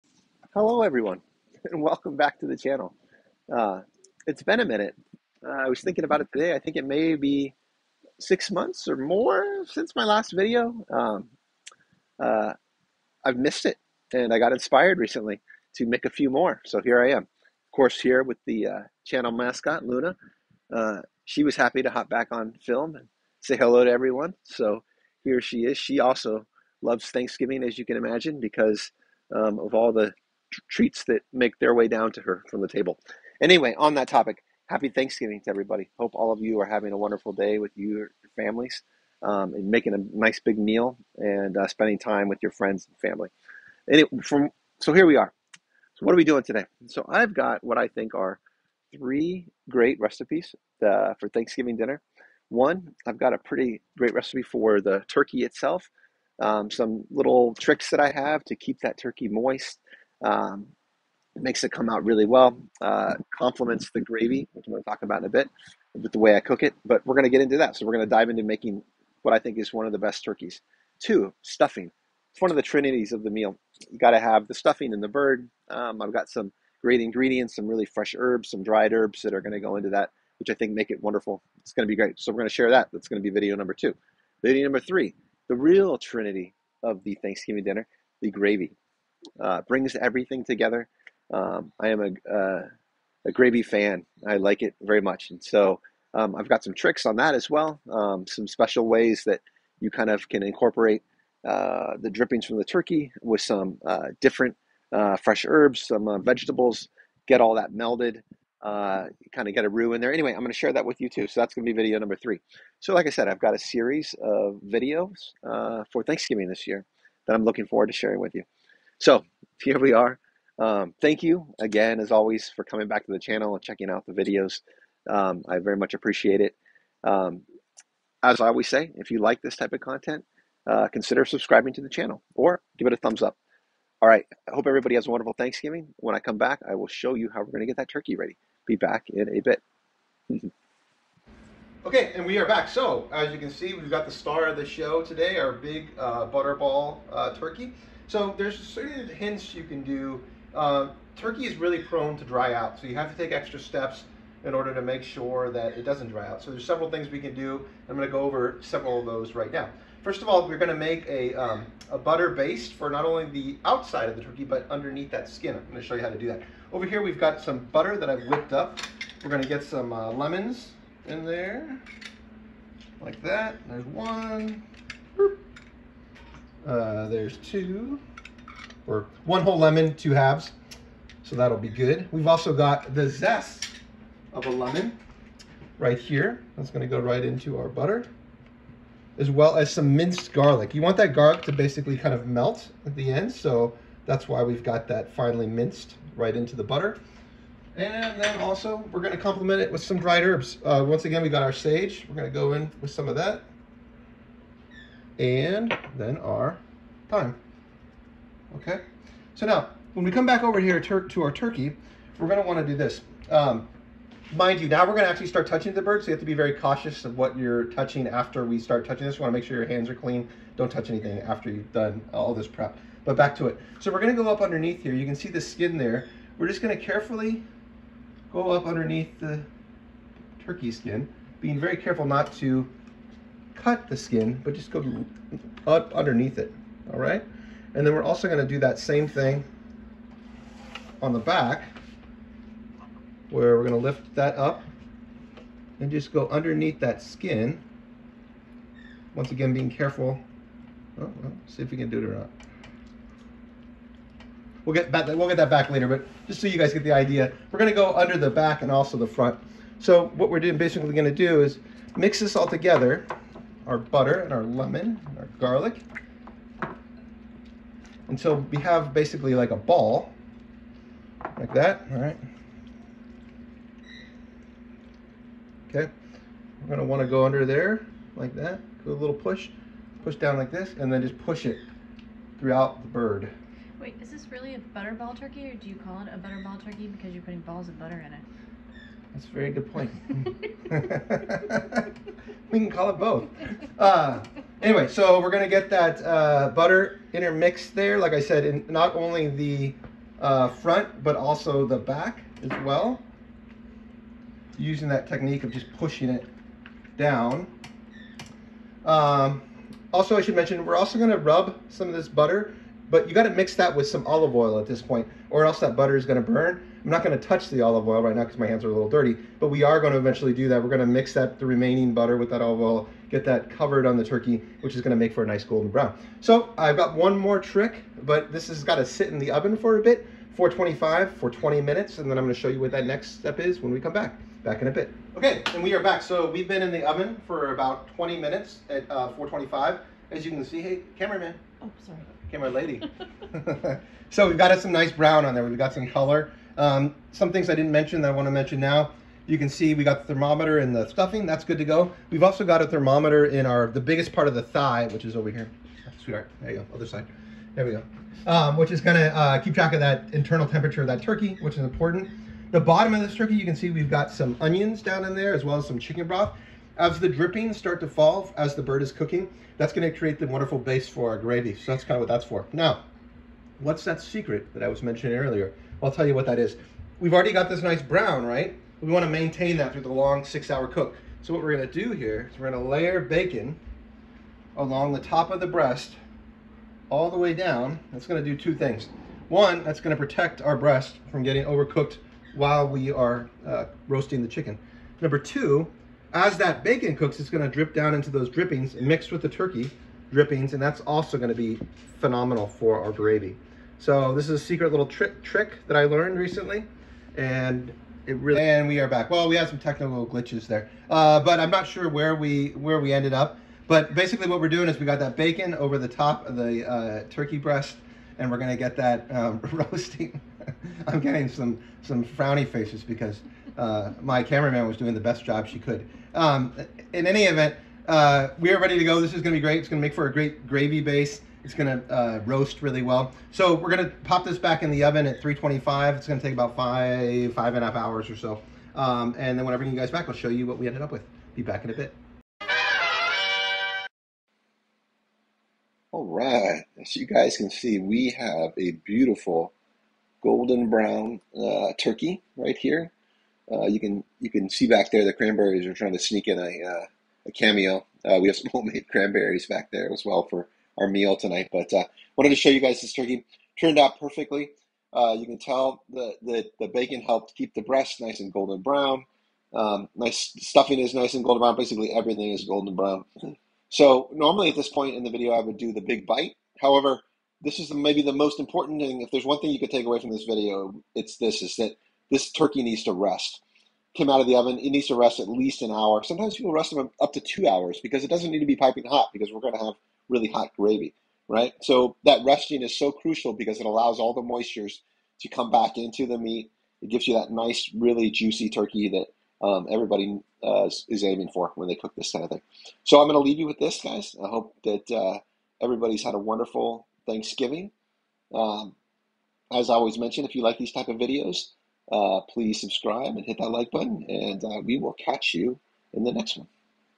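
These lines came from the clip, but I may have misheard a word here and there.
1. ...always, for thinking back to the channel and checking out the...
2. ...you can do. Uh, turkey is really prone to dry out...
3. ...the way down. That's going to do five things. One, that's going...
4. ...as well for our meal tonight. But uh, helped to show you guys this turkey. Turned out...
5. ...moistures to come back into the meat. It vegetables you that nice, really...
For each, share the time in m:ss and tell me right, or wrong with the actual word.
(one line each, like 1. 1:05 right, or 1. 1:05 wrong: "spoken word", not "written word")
1. 2:02 wrong: "coming", not "thinking"
2. 2:29 right
3. 6:27 wrong: "two", not "five"
4. 7:39 wrong: "wanted", not "helped"
5. 8:14 wrong: "gives", not "vegetables".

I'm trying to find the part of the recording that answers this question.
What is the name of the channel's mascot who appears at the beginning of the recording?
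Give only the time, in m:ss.
0:19.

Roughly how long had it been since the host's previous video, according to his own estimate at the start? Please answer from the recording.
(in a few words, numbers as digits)
6 months.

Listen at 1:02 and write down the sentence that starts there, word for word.
Uh, complements the gravy, which I'm going to talk about in a bit, with the way I cook it.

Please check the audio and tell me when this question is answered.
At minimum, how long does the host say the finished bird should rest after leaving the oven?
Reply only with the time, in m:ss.
8:05.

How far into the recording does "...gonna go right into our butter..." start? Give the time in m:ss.
3:06.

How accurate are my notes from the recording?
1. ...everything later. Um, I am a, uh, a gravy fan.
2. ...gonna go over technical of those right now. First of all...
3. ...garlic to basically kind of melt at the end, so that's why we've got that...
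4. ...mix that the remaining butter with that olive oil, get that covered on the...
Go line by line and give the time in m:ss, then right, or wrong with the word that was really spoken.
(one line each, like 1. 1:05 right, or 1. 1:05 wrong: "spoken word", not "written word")
1. 1:29 wrong: "together", not "later"
2. 2:37 wrong: "several", not "technical"
3. 3:11 right
4. 5:20 right.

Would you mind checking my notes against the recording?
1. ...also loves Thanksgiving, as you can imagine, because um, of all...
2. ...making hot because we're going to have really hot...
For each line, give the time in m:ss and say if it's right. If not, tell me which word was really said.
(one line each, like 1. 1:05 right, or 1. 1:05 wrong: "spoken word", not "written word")
1. 0:26 right
2. 8:08 wrong: "piping", not "making".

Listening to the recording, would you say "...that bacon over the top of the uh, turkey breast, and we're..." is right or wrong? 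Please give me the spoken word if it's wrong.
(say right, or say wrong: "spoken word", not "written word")
right.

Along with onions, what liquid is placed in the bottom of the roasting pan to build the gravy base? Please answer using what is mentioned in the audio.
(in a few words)
Chicken broth.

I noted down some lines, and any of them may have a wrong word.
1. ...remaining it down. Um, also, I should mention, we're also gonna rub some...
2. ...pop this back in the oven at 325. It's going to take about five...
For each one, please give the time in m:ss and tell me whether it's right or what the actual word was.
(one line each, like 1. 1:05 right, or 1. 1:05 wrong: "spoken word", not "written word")
1. 5:05 wrong: "pushing", not "remaining"
2. 7:14 right.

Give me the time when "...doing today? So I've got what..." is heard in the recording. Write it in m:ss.
0:46.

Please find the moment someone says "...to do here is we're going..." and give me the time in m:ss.
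6:21.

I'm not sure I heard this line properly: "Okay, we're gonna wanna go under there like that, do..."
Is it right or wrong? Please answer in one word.
right.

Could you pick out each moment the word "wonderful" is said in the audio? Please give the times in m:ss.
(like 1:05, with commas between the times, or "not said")
0:36, 1:21, 2:15, 6:10, 8:26.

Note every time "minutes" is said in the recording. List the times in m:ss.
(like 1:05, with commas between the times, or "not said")
0:04, 5:31, 5:38.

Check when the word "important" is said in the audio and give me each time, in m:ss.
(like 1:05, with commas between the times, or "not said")
6:01, 7:58.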